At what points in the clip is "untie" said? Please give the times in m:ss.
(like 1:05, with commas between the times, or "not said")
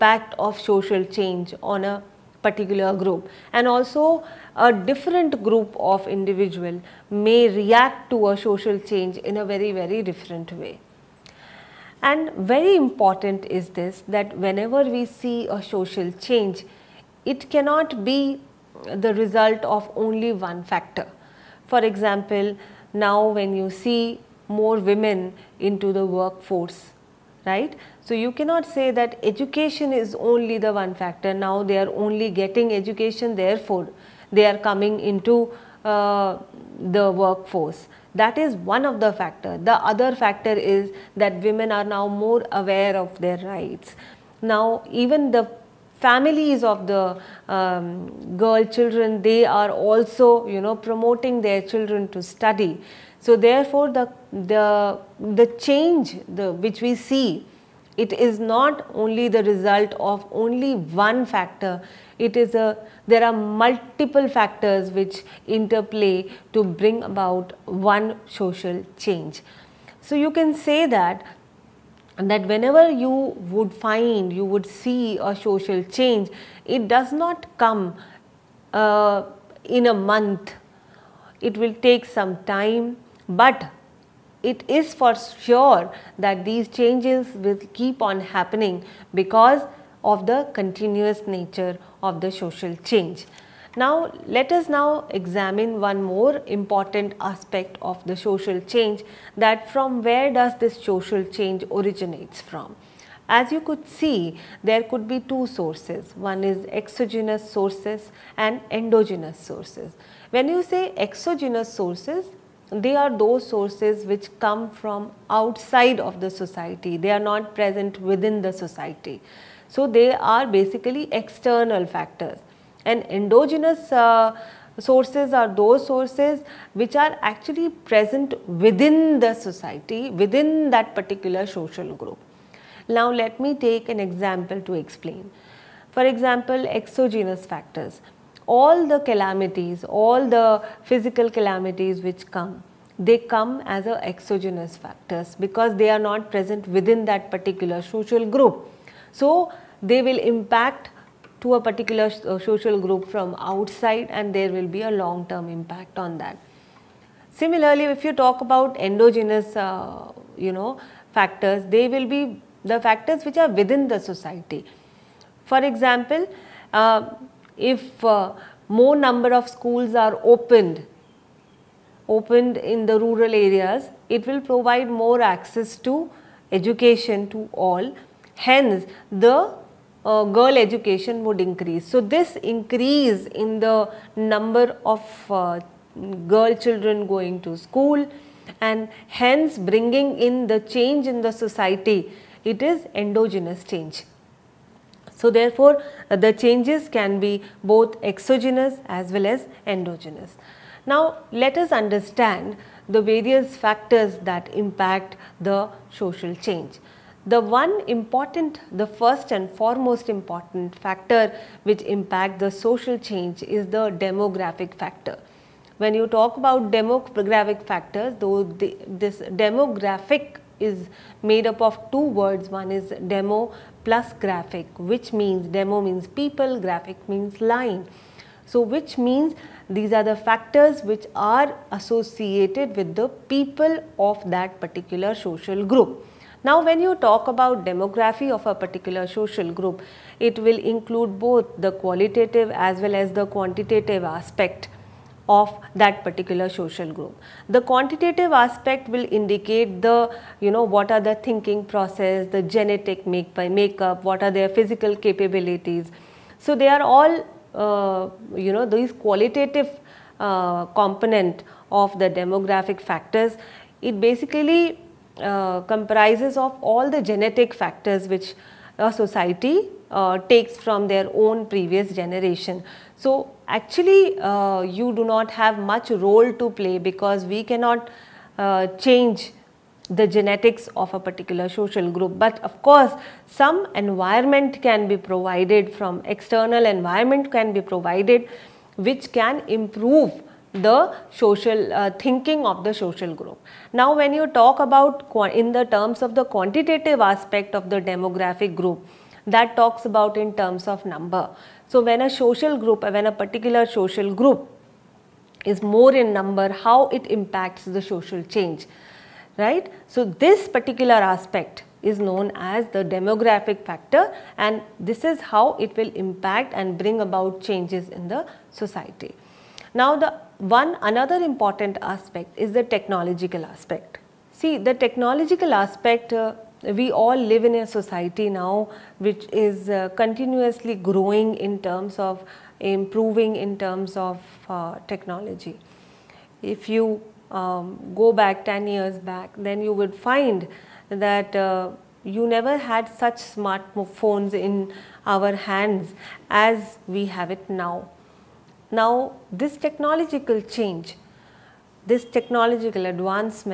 not said.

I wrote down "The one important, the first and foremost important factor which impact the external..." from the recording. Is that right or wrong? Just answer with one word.
wrong.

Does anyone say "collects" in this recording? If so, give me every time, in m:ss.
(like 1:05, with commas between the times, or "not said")
not said.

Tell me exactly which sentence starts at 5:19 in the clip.
Now the one another important aspect is the technological aspect.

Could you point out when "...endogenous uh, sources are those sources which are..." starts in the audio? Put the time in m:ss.
2:03.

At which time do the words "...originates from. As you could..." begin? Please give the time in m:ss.
1:41.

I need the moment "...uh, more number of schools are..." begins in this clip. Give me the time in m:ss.
2:48.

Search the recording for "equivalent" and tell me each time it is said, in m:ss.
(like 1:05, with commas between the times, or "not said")
not said.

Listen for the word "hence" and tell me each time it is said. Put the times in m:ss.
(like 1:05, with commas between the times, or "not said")
2:58, 3:09.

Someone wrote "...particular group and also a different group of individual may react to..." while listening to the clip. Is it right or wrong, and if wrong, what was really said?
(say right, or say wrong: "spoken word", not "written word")
right.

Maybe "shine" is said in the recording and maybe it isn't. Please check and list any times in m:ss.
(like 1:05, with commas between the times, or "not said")
not said.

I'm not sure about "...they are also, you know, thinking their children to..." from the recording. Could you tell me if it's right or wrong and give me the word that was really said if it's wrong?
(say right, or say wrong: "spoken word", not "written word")
wrong: "promoting", not "thinking".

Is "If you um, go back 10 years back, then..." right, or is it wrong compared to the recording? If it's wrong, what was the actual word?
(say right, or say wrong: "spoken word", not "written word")
right.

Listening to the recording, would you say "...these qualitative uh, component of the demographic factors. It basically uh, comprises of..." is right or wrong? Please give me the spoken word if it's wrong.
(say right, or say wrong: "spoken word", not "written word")
right.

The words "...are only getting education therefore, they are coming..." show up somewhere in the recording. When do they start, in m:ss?
0:31.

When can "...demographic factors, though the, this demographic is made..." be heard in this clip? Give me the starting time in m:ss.
3:36.